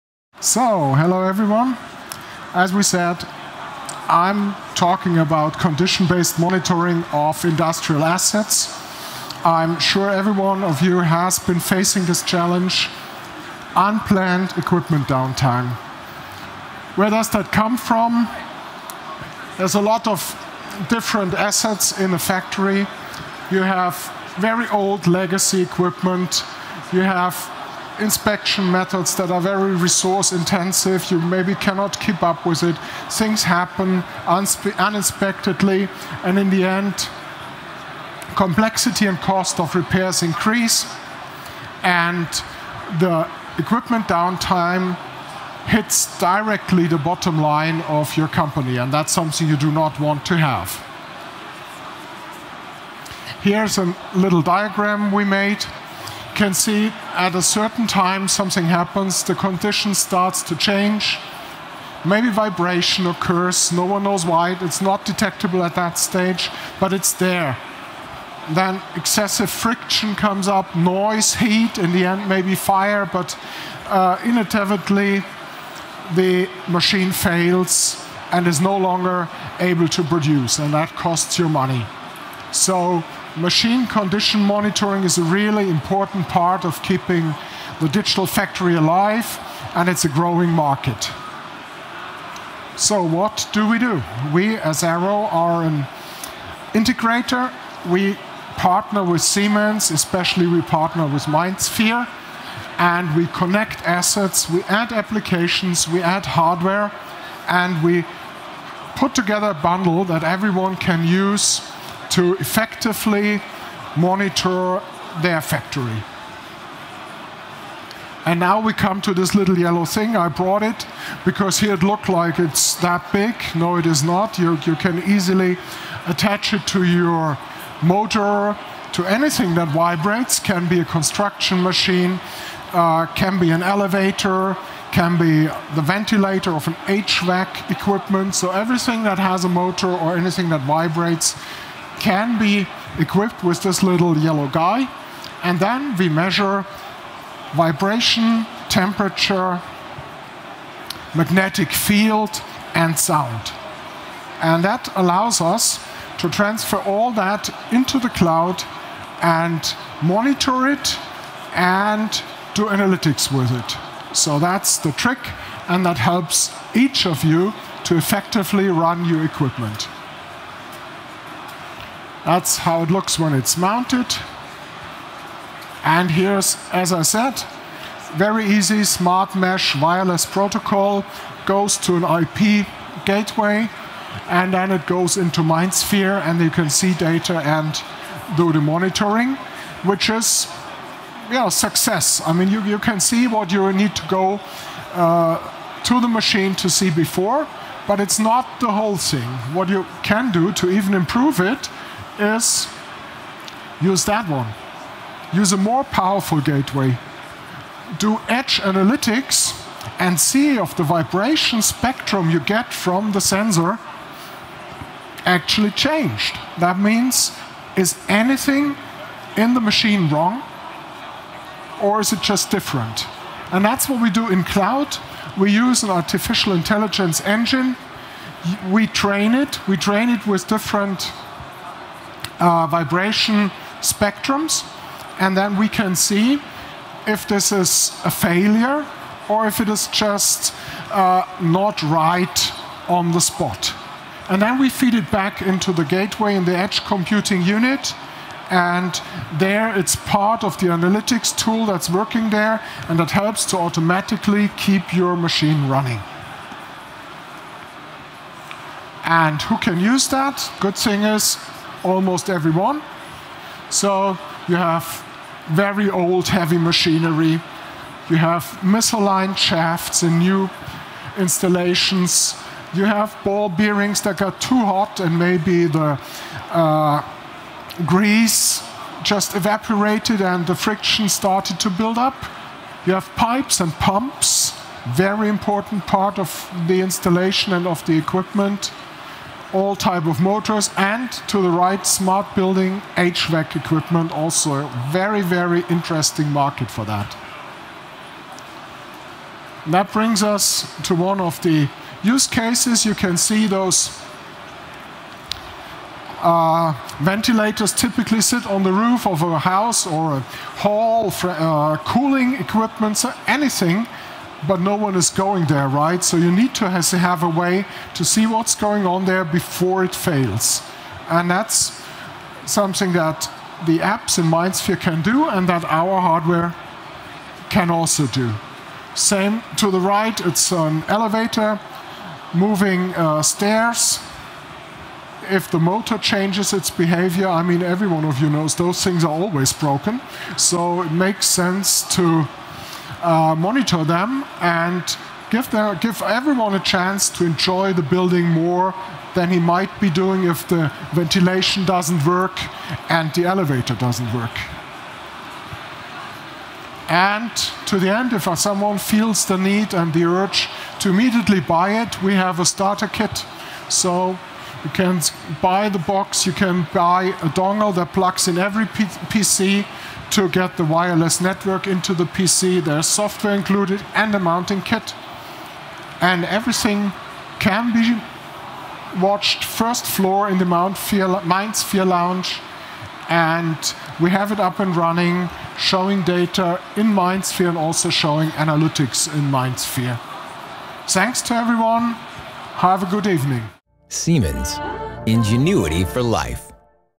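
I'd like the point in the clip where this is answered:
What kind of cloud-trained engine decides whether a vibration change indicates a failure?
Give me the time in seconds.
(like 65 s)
225 s.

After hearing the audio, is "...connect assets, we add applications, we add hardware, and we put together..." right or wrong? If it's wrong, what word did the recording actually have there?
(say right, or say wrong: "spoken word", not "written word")
right.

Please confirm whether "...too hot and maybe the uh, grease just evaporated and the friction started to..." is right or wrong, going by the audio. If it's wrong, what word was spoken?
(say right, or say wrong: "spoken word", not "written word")
right.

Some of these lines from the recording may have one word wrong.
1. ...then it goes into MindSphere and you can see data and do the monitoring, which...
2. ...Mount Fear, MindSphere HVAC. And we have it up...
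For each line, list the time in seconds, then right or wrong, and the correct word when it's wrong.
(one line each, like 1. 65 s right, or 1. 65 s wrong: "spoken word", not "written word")
1. 184 s right
2. 380 s wrong: "Lounge", not "HVAC".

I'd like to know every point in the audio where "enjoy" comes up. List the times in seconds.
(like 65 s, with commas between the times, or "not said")
347 s.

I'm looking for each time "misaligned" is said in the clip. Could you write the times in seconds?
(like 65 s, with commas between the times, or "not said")
268 s.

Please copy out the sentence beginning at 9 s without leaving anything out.
I'm sure every one of you has been facing this challenge, unplanned equipment downtime.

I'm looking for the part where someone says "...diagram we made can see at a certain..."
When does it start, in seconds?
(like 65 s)
54 s.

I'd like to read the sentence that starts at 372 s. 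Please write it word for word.
There's software included and a mounting kit.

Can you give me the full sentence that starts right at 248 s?
And there it's part of the analytics tool that's working there and that helps to automatically keep your machine running.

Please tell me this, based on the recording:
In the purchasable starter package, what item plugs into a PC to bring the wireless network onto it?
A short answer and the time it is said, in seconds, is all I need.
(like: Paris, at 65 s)
a dongle, at 367 s.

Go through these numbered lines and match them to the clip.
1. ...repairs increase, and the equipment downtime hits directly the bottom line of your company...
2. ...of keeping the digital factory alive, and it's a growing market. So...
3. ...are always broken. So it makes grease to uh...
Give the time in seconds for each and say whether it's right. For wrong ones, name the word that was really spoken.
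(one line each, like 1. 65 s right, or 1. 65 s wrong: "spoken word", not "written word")
1. 39 s right
2. 86 s right
3. 339 s wrong: "sense", not "grease".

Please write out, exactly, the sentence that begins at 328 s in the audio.
Same to the right, it's an elevator, moving uh, stairs.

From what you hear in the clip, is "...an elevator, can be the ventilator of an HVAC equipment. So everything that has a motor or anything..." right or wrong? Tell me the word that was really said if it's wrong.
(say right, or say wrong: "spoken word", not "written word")
right.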